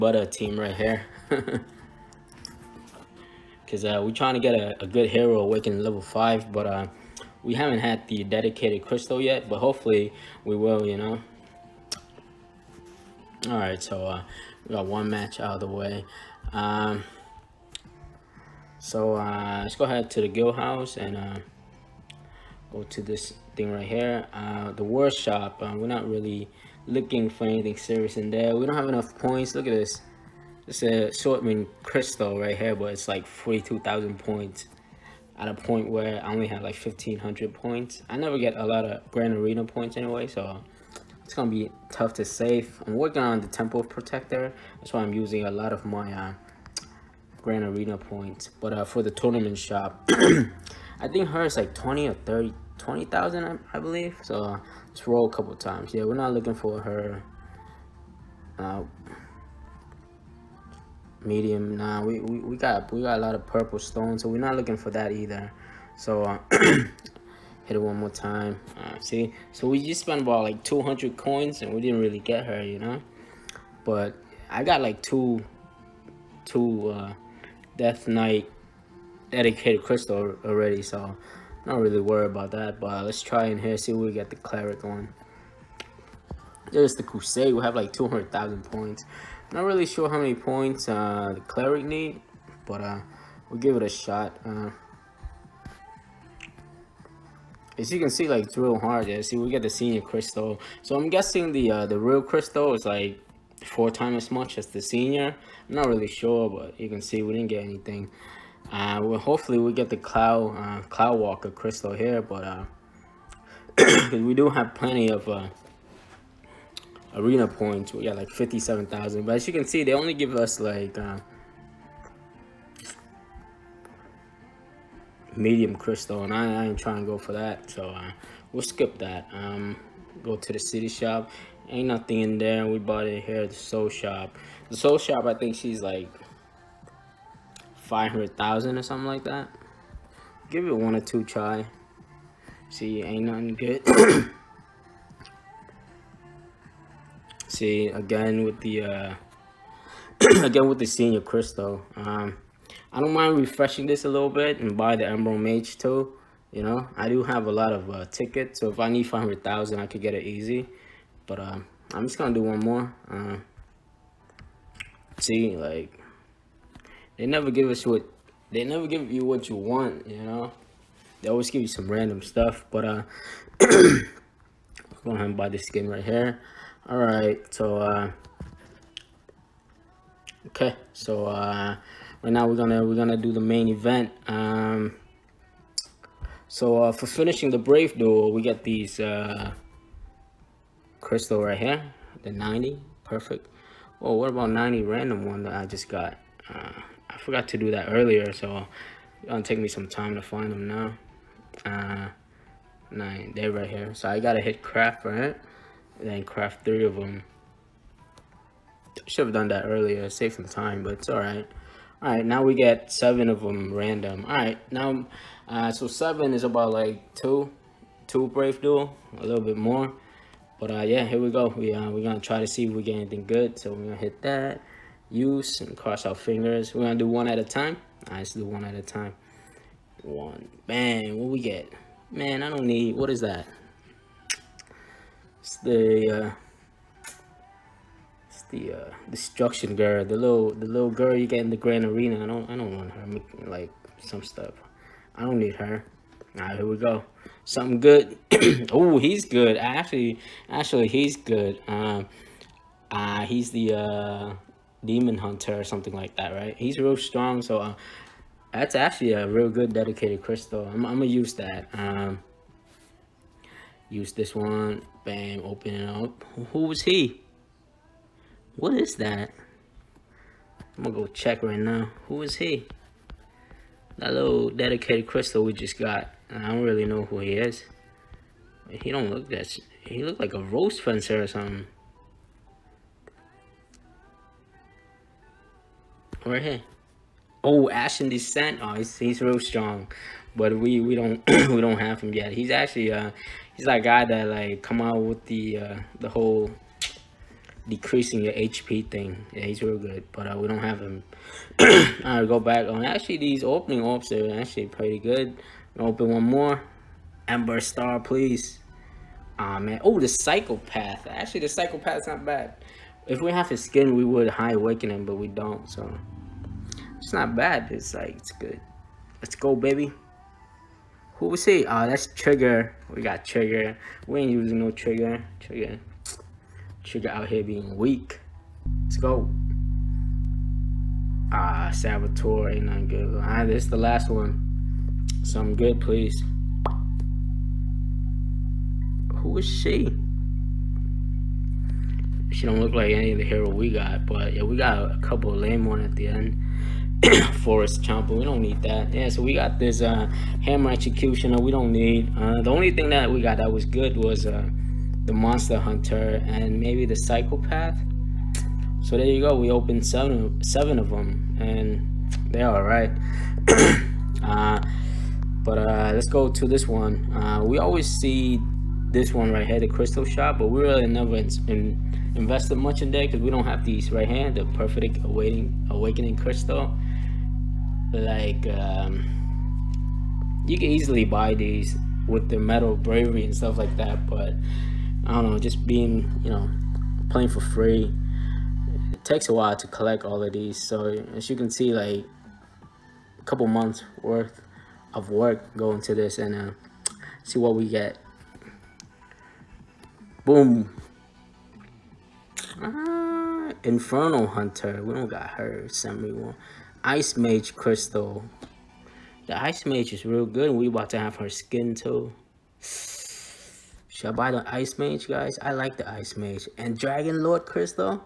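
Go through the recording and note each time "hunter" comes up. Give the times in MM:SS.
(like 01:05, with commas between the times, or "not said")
04:15, 05:55, 06:44.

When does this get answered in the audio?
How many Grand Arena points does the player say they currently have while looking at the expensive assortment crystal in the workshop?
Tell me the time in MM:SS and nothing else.
00:36.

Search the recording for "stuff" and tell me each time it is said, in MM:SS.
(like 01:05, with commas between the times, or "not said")
02:52, 04:04, 06:23.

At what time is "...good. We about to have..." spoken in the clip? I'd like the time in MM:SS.
06:50.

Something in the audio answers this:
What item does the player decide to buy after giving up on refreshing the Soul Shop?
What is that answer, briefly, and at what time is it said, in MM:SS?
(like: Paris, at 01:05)
This skin, at 02:55.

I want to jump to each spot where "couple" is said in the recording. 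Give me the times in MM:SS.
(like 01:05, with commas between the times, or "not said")
00:55, 05:44, 06:33.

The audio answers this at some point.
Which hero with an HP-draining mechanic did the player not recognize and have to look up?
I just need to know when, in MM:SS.
04:47.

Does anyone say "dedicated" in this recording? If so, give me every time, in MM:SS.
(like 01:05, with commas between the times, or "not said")
00:08, 01:19, 04:19, 04:34.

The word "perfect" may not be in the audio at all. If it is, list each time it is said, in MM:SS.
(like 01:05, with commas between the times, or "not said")
03:13, 06:14.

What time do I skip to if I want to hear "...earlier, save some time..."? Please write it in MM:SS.
03:29.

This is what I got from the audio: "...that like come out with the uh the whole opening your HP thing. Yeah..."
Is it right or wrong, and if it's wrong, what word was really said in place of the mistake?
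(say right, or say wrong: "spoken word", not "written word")
wrong: "decreasing", not "opening".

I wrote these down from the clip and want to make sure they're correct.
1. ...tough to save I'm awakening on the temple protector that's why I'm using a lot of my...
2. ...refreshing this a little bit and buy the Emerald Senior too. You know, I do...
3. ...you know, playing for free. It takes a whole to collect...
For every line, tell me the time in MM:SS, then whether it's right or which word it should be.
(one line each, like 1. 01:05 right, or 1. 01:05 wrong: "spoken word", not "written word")
1. 00:41 wrong: "working", not "awakening"
2. 02:33 wrong: "Mage", not "Senior"
3. 06:26 wrong: "while", not "whole".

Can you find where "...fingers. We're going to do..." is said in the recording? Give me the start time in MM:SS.
03:46.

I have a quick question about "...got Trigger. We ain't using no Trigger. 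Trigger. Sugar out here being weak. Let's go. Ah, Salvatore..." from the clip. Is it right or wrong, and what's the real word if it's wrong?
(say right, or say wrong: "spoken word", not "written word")
right.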